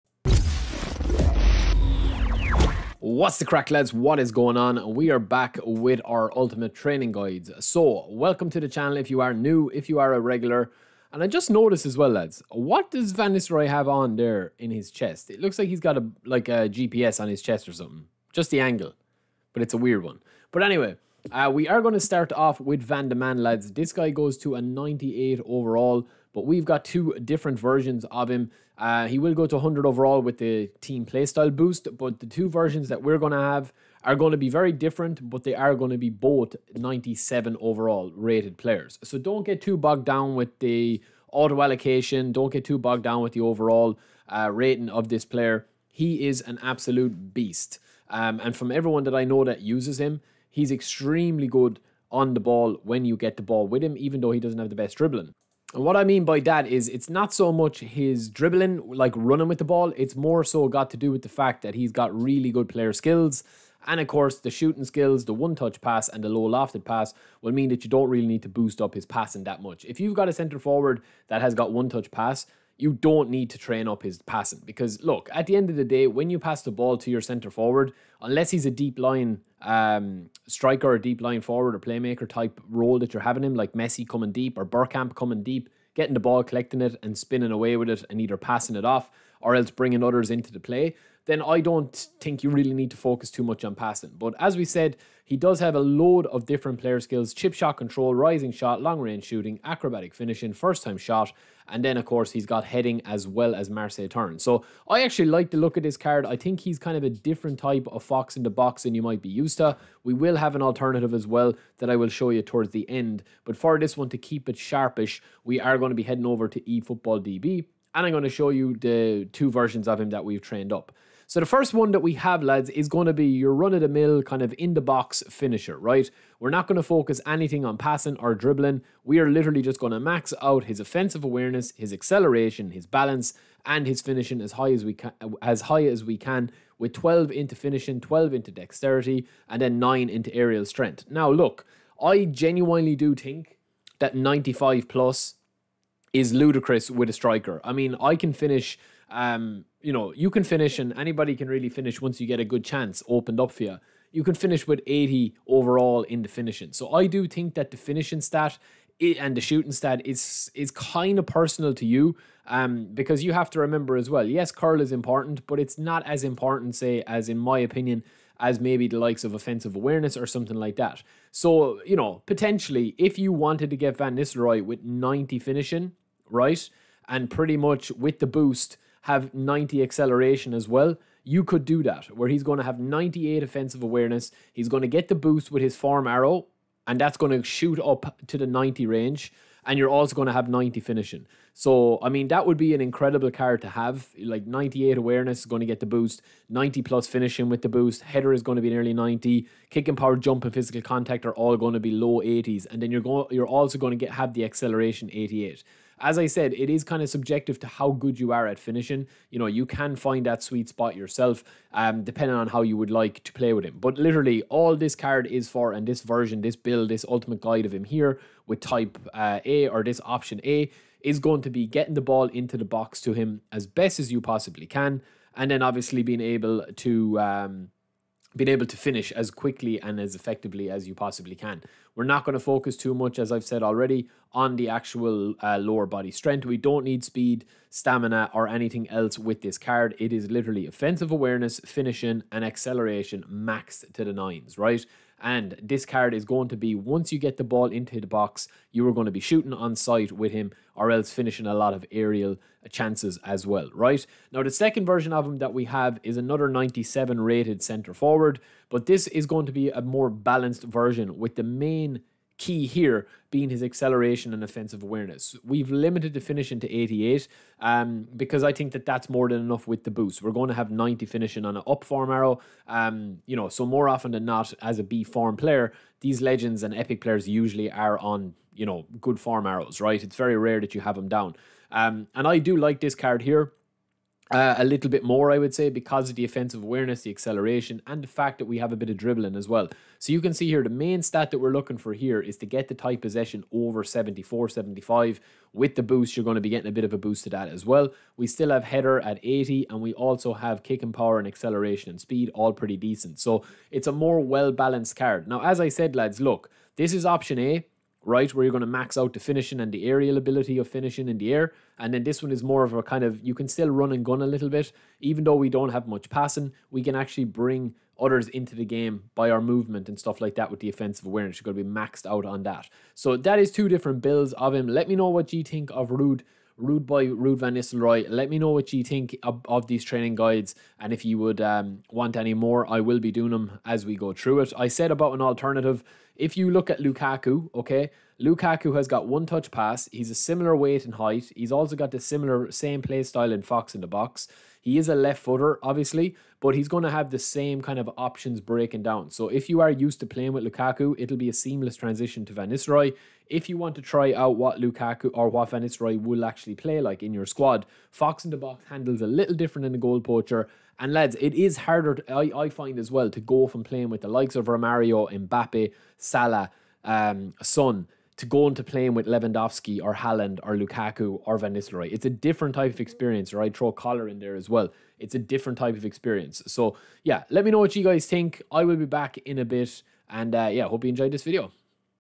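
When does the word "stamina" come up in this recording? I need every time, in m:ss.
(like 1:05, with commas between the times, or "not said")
3:57.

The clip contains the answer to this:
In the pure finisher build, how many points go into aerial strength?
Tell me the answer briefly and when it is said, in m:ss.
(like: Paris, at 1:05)
9, at 2:19.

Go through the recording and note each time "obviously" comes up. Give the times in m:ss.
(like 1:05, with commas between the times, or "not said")
3:45, 5:45.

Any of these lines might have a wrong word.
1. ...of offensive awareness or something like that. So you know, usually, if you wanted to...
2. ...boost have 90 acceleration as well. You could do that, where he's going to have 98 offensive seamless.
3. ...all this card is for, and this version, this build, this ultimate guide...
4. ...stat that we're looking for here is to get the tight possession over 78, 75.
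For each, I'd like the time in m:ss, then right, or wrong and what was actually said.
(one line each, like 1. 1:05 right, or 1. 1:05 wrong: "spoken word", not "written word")
1. 2:49 wrong: "potentially", not "usually"
2. 2:58 wrong: "awareness", not "seamless"
3. 3:34 right
4. 4:51 wrong: "74", not "78".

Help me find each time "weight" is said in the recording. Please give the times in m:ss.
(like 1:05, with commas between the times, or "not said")
5:40.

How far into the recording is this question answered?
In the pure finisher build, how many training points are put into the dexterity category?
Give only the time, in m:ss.
2:18.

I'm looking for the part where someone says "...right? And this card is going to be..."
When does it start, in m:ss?
4:04.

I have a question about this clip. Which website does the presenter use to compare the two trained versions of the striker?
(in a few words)
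eFootball DB.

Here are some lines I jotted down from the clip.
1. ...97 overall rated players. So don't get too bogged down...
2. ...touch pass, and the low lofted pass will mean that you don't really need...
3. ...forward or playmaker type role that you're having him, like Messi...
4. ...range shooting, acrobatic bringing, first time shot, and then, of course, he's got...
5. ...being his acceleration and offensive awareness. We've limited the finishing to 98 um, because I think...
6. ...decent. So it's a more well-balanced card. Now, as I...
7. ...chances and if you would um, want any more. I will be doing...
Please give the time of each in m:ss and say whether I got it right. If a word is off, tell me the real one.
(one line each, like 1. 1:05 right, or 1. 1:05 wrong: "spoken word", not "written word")
1. 0:36 right
2. 1:05 right
3. 1:21 right
4. 1:38 wrong: "finishing", not "bringing"
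5. 4:23 wrong: "88", not "98"
6. 5:02 right
7. 5:30 wrong: "guides", not "chances".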